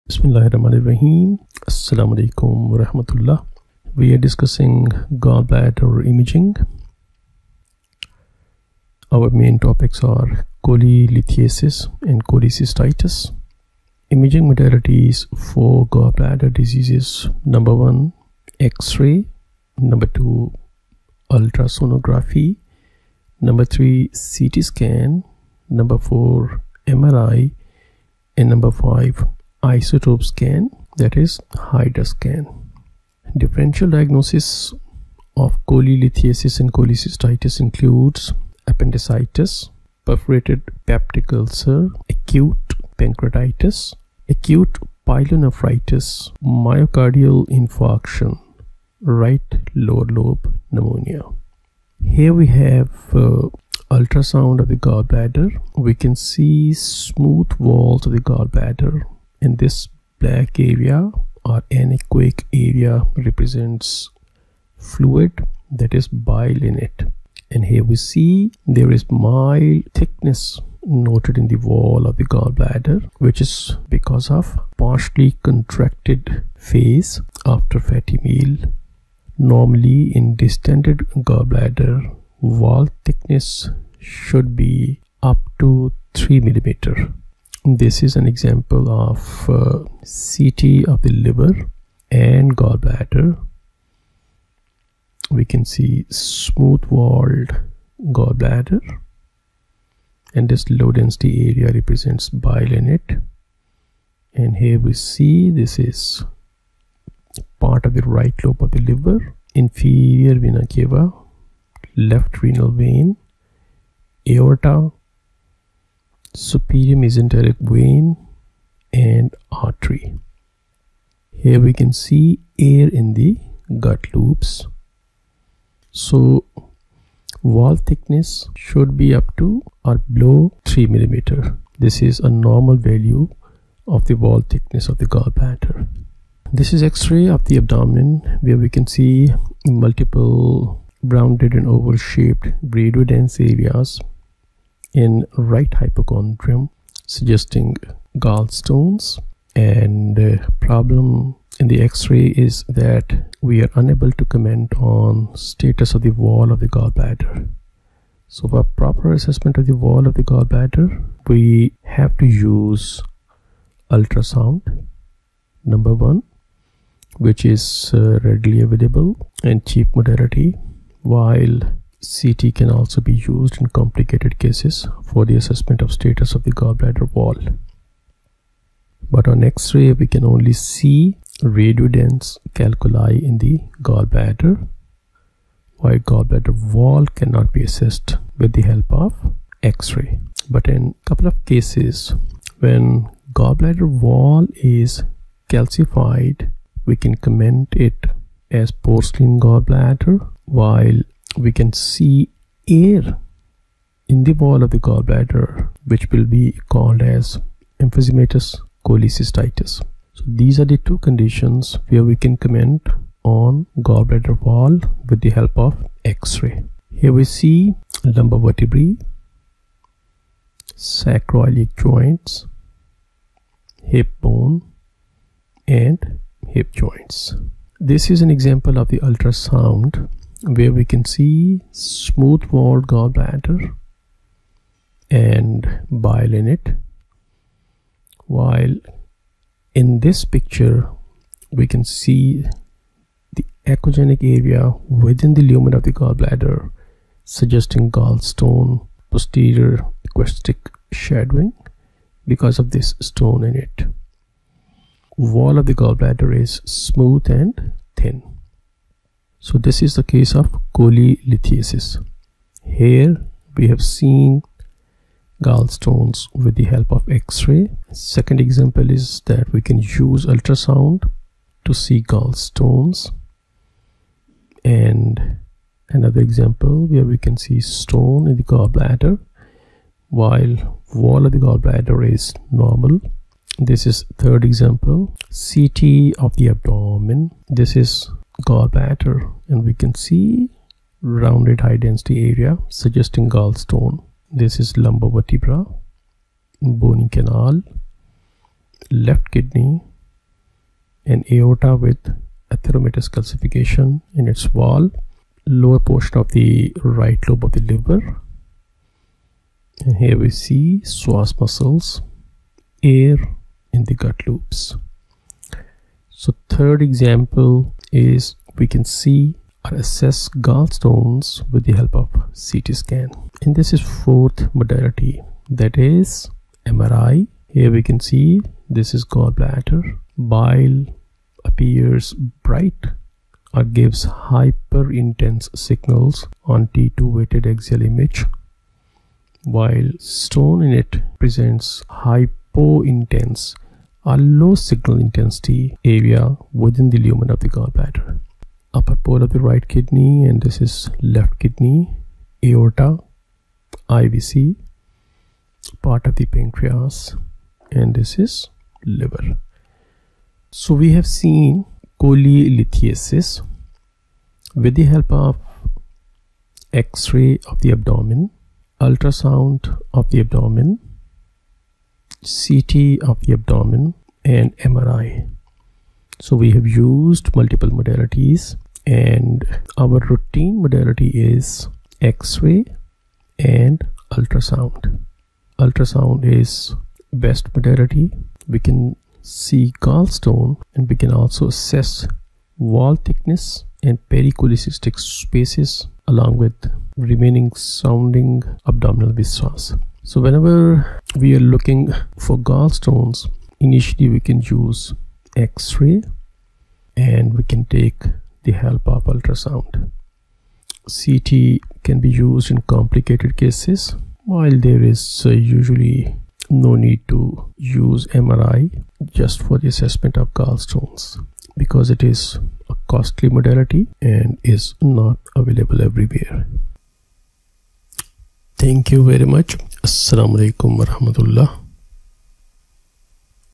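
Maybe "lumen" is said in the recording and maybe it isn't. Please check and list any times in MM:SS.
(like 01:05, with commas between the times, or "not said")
04:05, 05:46.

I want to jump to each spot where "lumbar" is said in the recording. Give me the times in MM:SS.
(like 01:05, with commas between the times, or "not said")
03:38, 04:54.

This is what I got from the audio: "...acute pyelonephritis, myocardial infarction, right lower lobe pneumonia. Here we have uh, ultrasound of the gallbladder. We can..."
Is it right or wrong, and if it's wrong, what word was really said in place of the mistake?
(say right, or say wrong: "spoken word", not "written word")
right.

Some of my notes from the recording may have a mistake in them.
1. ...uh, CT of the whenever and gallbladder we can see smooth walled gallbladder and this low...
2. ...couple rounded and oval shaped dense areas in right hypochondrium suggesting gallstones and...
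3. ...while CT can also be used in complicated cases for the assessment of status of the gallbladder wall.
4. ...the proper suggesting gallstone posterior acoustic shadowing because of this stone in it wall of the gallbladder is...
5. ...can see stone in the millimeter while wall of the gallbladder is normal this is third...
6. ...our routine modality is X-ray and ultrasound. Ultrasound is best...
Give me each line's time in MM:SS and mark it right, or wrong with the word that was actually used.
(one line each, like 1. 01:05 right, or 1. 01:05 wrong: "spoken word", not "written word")
1. 01:29 wrong: "liver", not "whenever"
2. 02:19 wrong: "multiple", not "couple"
3. 02:51 right
4. 04:05 wrong: "gallbladder", not "proper"
5. 04:37 wrong: "gallbladder", not "millimeter"
6. 06:19 right.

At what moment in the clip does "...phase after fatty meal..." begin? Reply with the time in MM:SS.
01:16.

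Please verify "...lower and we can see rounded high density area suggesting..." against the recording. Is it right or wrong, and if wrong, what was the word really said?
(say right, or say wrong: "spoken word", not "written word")
wrong: "gallbladder", not "lower".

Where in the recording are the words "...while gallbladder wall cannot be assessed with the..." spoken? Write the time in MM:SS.
03:05.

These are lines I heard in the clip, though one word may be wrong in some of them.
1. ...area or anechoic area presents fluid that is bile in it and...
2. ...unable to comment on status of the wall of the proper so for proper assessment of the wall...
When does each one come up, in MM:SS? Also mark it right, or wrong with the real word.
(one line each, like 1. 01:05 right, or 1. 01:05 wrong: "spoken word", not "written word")
1. 01:00 wrong: "represents", not "presents"
2. 02:33 wrong: "gallbladder", not "proper".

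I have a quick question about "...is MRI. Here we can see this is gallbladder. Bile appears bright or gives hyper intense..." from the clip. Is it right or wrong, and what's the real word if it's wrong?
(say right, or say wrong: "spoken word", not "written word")
right.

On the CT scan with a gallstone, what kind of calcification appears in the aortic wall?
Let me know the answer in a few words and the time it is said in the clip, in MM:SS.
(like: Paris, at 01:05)
atheromatous, at 05:02.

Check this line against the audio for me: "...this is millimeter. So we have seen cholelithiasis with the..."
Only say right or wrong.
wrong.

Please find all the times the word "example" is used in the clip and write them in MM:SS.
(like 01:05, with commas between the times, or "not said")
01:28, 03:48, 04:28, 04:36, 04:44, 05:16.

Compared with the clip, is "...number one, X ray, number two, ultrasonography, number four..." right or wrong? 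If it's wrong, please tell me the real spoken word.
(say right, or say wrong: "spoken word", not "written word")
wrong: "three", not "four".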